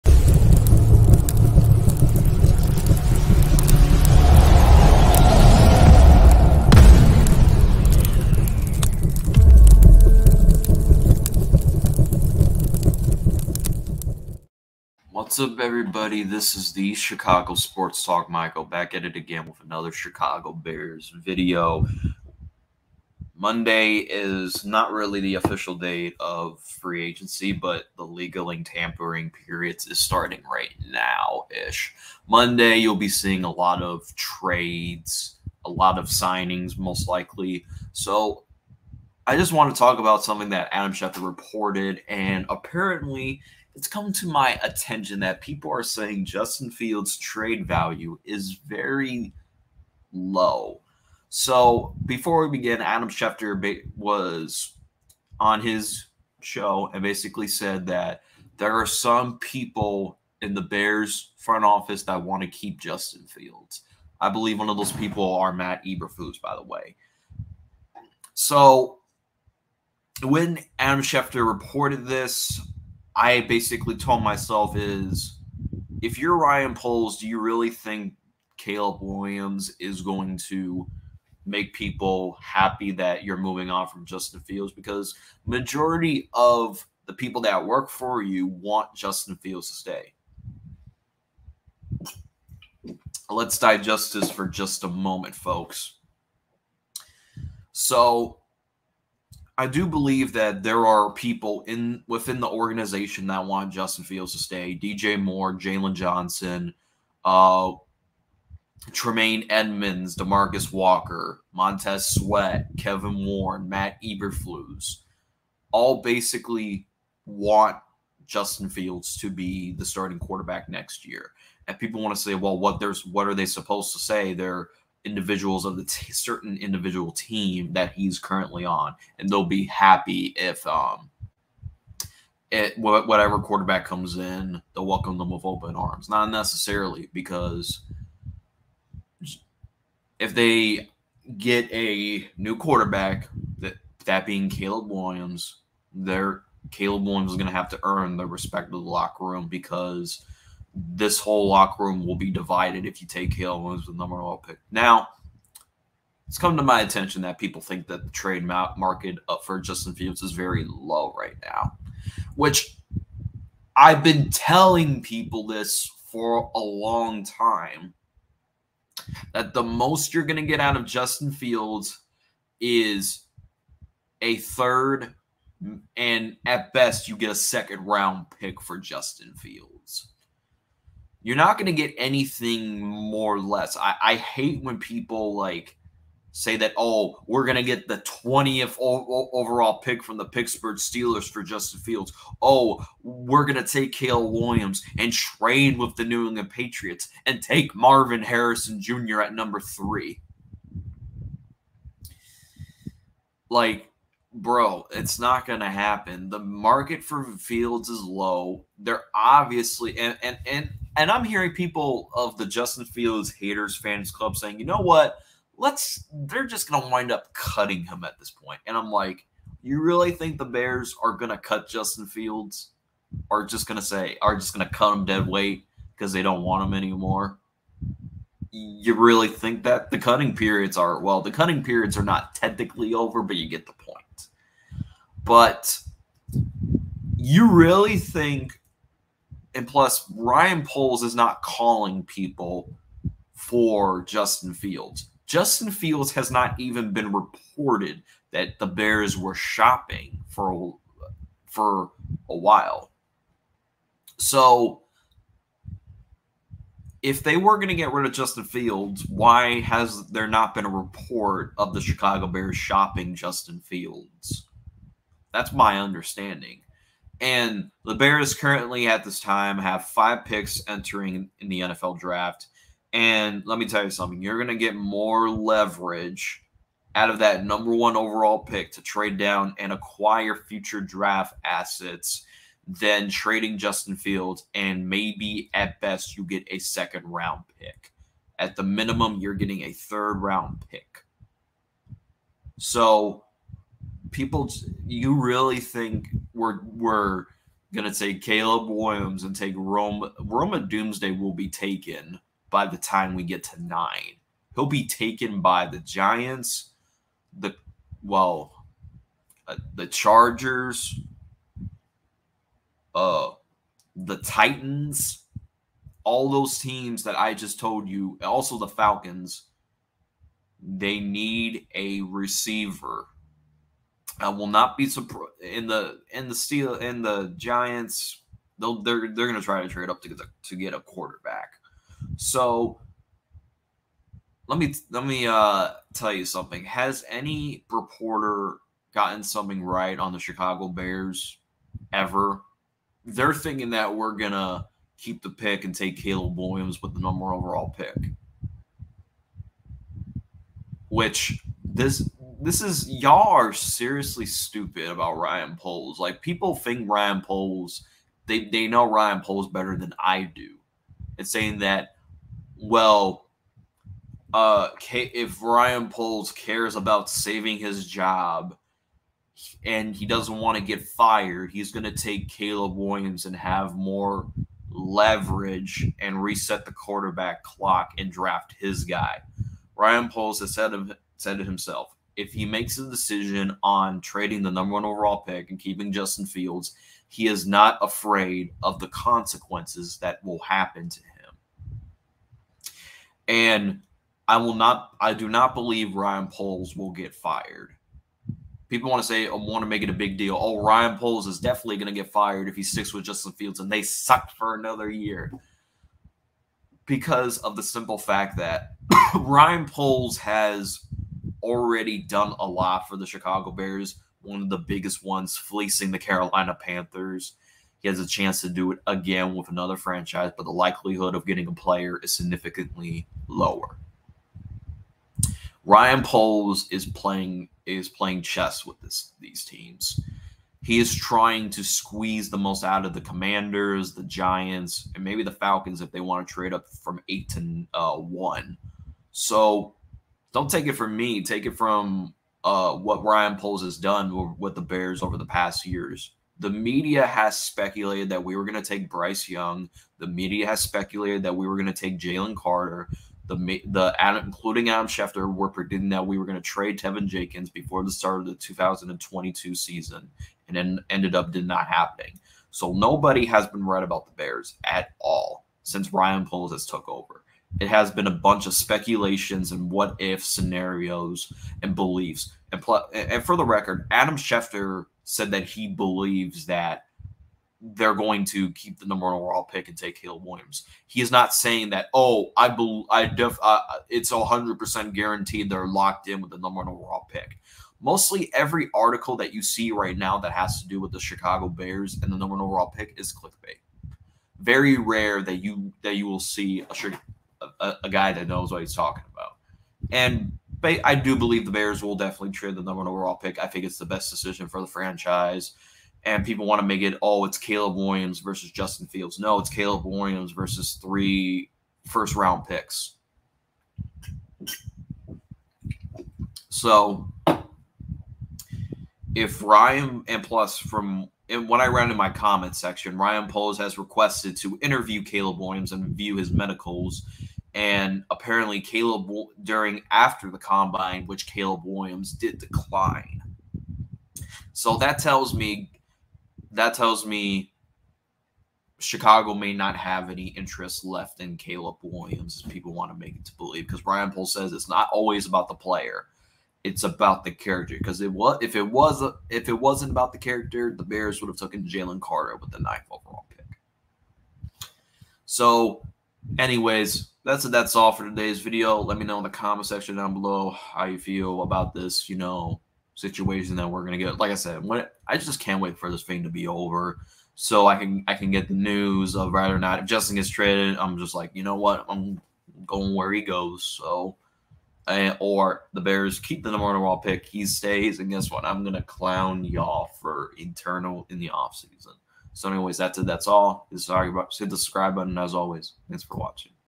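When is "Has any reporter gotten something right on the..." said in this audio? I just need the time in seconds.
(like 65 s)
336 s.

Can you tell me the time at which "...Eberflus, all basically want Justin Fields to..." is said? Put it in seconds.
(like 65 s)
114 s.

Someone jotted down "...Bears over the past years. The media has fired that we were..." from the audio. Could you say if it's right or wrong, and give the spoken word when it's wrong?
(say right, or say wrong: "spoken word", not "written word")
wrong: "speculated", not "fired".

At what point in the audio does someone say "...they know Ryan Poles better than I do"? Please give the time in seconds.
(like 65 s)
358 s.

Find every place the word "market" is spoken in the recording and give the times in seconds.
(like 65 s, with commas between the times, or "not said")
158 s, 206 s.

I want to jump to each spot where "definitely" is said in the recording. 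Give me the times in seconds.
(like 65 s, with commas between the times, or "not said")
401 s, 501 s.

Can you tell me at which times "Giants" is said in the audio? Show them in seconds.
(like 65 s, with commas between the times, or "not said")
305 s, 327 s, 434 s.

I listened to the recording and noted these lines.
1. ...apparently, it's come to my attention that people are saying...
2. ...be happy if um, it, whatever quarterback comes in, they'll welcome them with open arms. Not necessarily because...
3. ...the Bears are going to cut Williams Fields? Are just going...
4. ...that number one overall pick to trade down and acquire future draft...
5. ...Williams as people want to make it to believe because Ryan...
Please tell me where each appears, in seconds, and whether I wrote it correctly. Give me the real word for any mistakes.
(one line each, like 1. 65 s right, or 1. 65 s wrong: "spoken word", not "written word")
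1. 42 s right
2. 129 s right
3. 220 s wrong: "Justin", not "Williams"
4. 277 s right
5. 541 s right.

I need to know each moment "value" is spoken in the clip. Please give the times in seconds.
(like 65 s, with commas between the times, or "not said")
47 s.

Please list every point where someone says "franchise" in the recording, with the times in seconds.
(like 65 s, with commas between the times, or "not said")
419 s, 504 s.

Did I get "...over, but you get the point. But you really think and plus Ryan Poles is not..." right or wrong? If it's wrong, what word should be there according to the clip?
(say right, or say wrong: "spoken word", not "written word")
right.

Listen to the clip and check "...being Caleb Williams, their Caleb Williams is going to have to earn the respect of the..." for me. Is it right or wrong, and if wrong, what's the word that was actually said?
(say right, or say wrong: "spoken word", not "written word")
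right.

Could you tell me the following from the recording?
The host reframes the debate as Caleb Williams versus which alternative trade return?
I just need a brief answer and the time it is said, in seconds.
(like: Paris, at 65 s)
three first round picks, at 510 s.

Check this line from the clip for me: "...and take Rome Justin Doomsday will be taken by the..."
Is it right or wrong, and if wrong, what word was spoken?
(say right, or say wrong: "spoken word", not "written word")
wrong: "Roma", not "Justin".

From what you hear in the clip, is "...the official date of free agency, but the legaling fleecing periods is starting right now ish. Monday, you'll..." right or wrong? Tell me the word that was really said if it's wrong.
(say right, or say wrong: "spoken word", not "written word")
wrong: "tampering", not "fleecing".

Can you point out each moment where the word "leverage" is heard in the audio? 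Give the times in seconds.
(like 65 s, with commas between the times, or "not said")
275 s, 374 s.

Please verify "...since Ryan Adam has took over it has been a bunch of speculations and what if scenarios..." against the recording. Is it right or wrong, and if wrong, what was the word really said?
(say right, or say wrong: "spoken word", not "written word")
wrong: "Poles", not "Adam".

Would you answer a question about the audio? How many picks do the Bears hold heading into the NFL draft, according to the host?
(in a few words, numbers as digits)
5.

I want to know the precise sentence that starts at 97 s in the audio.
So I do believe that there are people in within the organization that want Justin Fields to stay.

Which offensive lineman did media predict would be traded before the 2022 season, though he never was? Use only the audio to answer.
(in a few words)
Teven Jenkins.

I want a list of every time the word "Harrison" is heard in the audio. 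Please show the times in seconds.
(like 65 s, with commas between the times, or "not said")
198 s.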